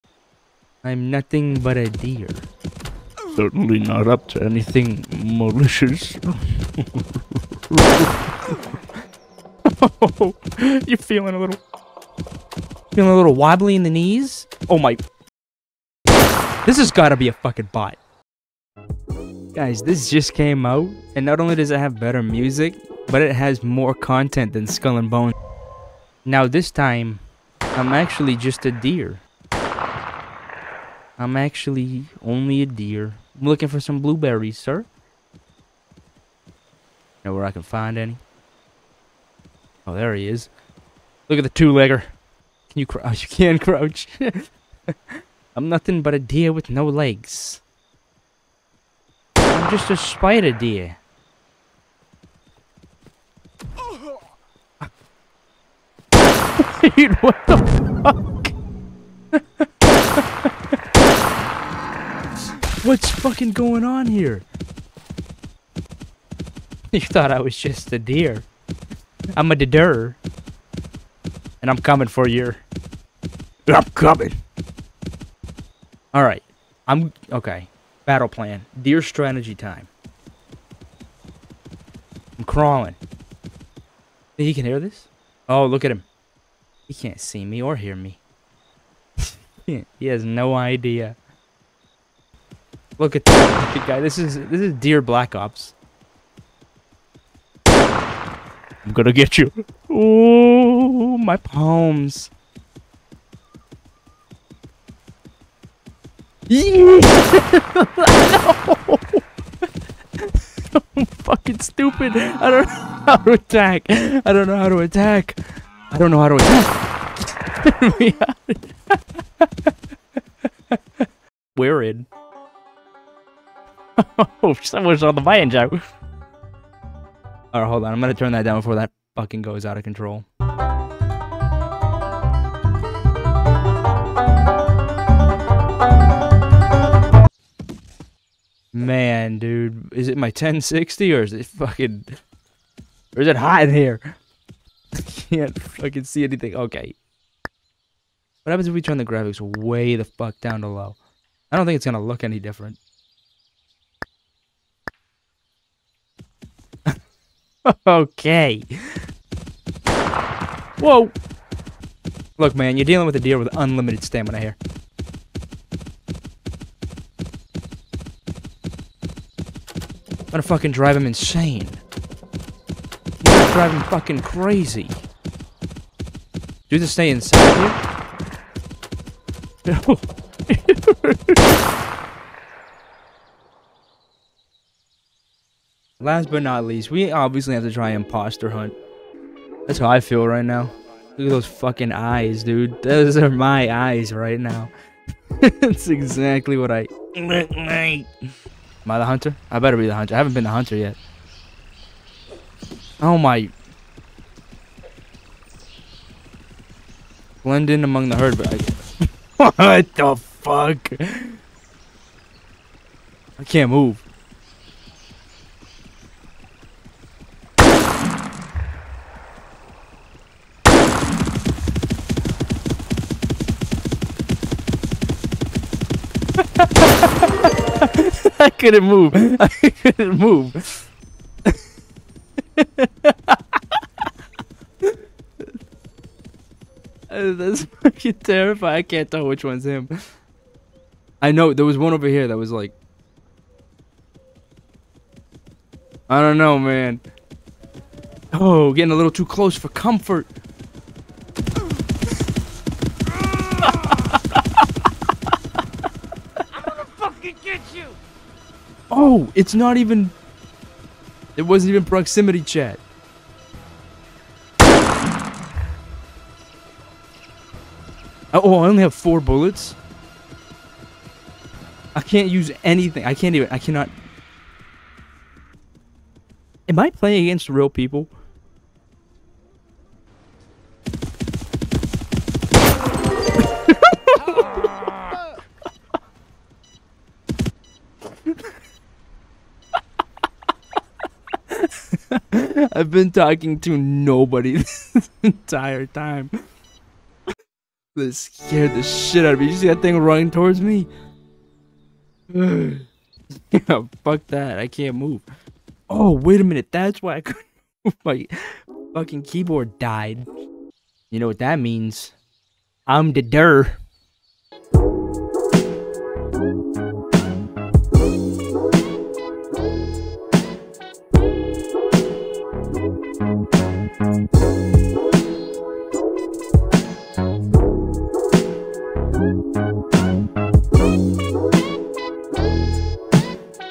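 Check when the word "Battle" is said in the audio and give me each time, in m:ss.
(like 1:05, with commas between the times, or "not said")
1:18.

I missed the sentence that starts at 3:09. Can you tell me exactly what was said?
That's how I feel right now.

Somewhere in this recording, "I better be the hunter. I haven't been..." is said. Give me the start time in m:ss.
3:19.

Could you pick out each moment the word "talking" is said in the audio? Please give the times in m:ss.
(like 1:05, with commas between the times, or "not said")
4:53.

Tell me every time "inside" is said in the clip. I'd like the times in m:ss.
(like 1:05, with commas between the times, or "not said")
2:57.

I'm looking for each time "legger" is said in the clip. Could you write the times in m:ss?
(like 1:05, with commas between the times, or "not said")
0:41.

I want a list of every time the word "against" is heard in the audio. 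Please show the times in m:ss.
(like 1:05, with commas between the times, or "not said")
4:37.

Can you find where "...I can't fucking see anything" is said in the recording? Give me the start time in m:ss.
2:24.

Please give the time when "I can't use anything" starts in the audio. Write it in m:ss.
4:31.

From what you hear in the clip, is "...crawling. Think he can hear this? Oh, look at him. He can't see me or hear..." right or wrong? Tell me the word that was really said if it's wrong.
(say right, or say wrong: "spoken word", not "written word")
right.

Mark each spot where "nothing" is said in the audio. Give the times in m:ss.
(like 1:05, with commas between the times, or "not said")
0:01, 0:45.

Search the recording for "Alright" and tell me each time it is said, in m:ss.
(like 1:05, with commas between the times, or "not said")
1:16, 2:07.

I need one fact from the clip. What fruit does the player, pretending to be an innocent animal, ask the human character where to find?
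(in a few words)
Blueberries.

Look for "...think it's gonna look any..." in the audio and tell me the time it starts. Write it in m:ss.
2:31.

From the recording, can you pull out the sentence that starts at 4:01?
I know there was one over here that was like.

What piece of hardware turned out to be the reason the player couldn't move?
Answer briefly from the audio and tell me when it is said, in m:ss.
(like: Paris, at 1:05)
Keyboard, at 5:09.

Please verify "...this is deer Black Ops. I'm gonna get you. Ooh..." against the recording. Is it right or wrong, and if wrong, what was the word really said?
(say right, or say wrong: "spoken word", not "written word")
right.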